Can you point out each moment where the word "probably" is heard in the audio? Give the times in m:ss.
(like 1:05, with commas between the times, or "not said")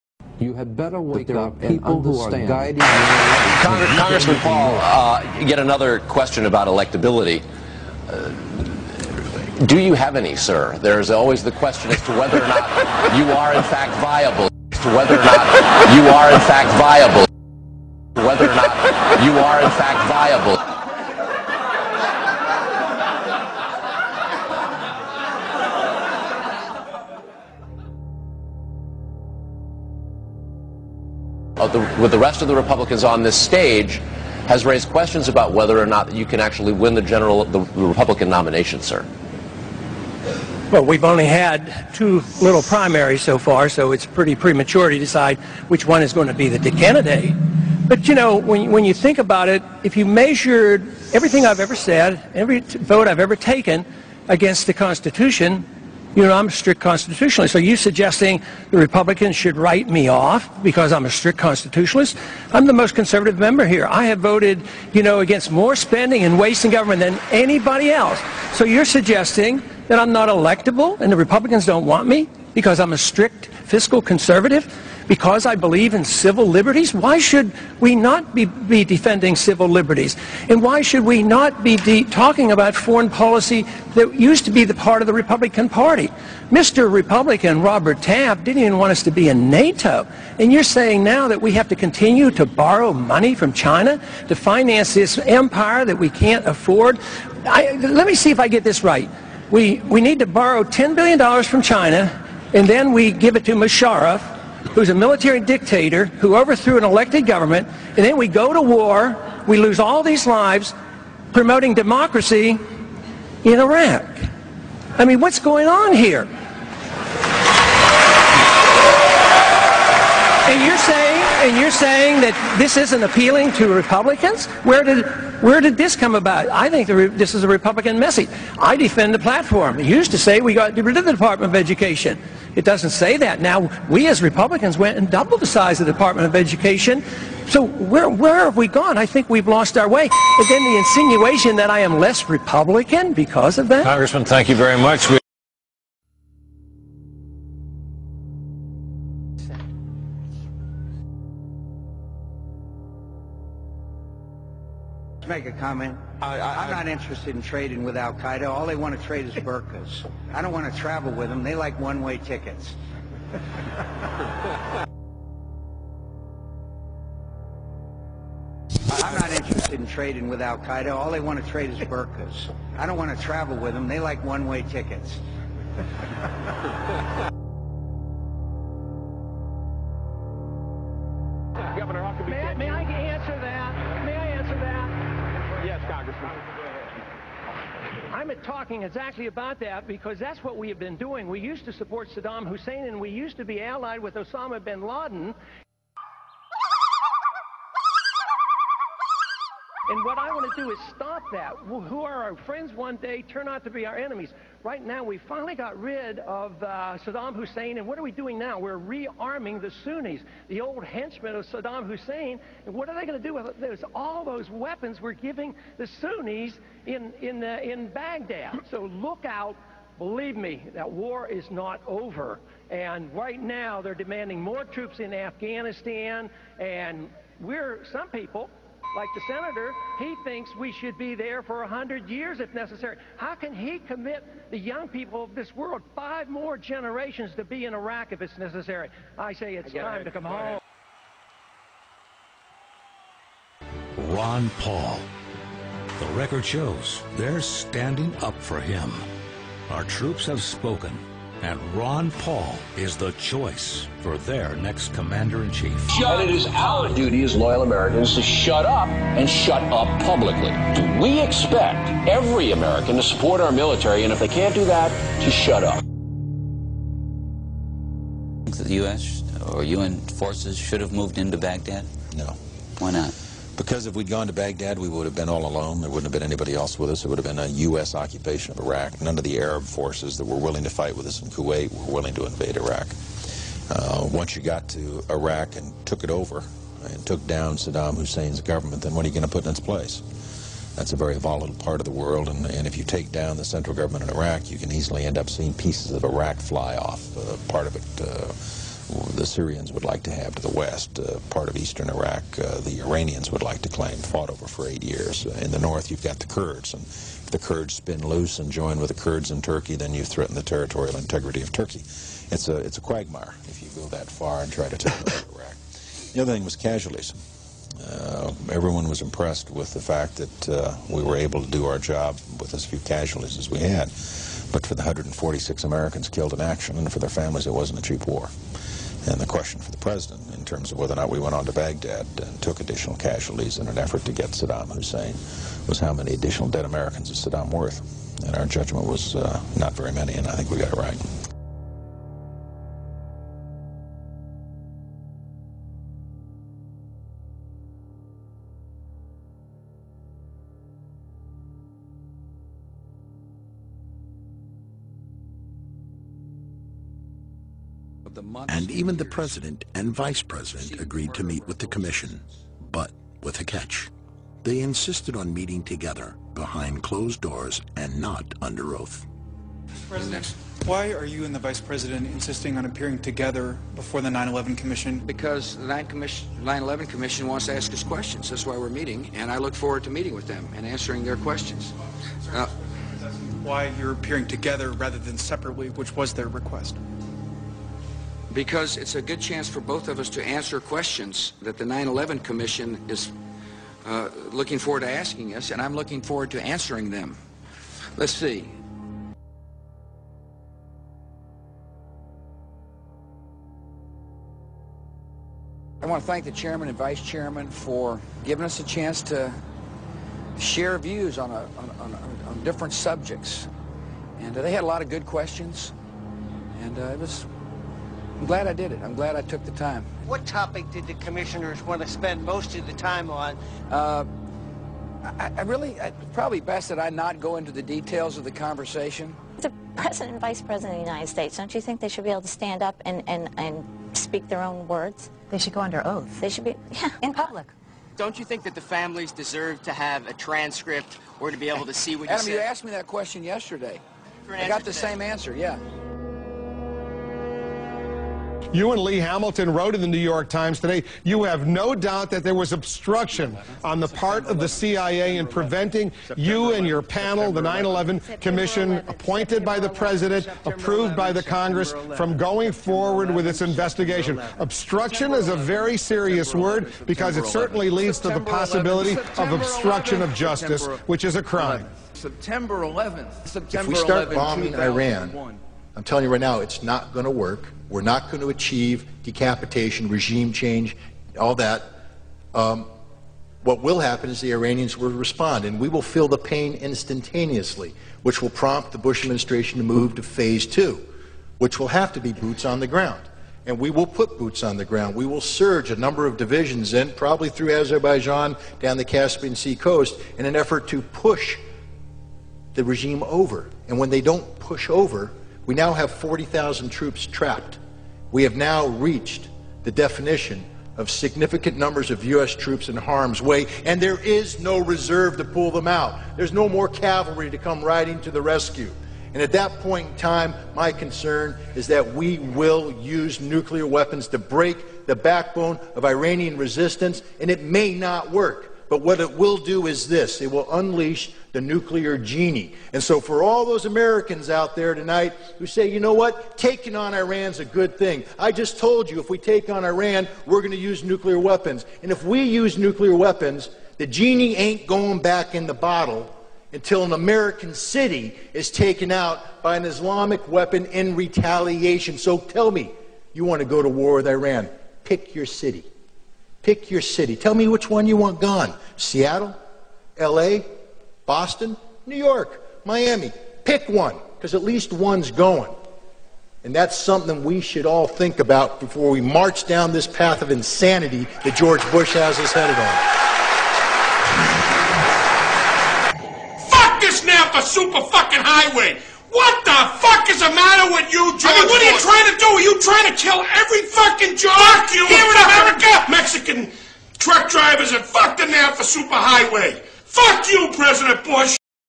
7:06, 8:16.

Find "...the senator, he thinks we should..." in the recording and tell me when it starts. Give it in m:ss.
3:49.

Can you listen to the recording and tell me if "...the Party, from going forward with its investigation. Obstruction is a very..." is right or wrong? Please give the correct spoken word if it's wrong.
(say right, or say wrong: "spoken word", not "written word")
wrong: "Congress", not "Party".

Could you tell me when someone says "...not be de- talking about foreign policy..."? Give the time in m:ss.
1:21.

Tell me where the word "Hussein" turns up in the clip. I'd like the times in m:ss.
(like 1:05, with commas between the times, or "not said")
3:12, 3:27, 3:31, 4:47, 5:34.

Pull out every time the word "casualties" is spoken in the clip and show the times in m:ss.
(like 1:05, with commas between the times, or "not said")
5:16, 5:22, 5:32.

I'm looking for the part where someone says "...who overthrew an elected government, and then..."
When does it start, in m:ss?
1:46.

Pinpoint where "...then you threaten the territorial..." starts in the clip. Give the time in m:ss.
5:09.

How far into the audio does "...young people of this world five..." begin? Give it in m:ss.
3:54.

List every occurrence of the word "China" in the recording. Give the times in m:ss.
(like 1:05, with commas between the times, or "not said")
1:33, 1:41.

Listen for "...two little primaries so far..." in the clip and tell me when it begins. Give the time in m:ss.
0:41.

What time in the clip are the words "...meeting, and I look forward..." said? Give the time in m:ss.
6:18.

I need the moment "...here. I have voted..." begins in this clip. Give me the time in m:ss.
1:03.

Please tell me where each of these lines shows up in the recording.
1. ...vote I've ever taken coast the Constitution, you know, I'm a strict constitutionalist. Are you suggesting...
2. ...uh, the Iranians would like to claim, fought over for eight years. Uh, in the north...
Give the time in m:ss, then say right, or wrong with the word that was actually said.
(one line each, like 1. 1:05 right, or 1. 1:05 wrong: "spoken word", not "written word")
1. 0:52 wrong: "against", not "coast"
2. 5:02 right.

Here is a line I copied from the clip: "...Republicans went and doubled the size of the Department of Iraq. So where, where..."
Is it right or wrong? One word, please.
wrong.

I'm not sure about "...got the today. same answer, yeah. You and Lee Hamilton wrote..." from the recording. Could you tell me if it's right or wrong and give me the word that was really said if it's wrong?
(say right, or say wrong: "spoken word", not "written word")
right.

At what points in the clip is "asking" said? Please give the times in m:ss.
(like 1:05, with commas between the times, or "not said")
6:34.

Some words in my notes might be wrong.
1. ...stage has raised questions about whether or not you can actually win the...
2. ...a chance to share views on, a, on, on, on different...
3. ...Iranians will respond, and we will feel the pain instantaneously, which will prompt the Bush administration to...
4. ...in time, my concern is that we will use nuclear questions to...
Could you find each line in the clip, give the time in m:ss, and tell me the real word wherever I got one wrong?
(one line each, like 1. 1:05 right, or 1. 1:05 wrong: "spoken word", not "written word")
1. 0:33 right
2. 6:48 right
3. 8:04 right
4. 8:39 wrong: "weapons", not "questions".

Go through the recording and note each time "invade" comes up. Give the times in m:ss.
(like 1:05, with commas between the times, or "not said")
4:42.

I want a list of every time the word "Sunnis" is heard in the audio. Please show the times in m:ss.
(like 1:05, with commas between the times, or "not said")
3:29, 3:35.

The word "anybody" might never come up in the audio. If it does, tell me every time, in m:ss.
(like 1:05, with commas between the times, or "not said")
1:07, 4:36.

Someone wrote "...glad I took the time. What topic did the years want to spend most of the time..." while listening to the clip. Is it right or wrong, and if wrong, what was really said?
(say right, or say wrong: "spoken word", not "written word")
wrong: "commissioners", not "years".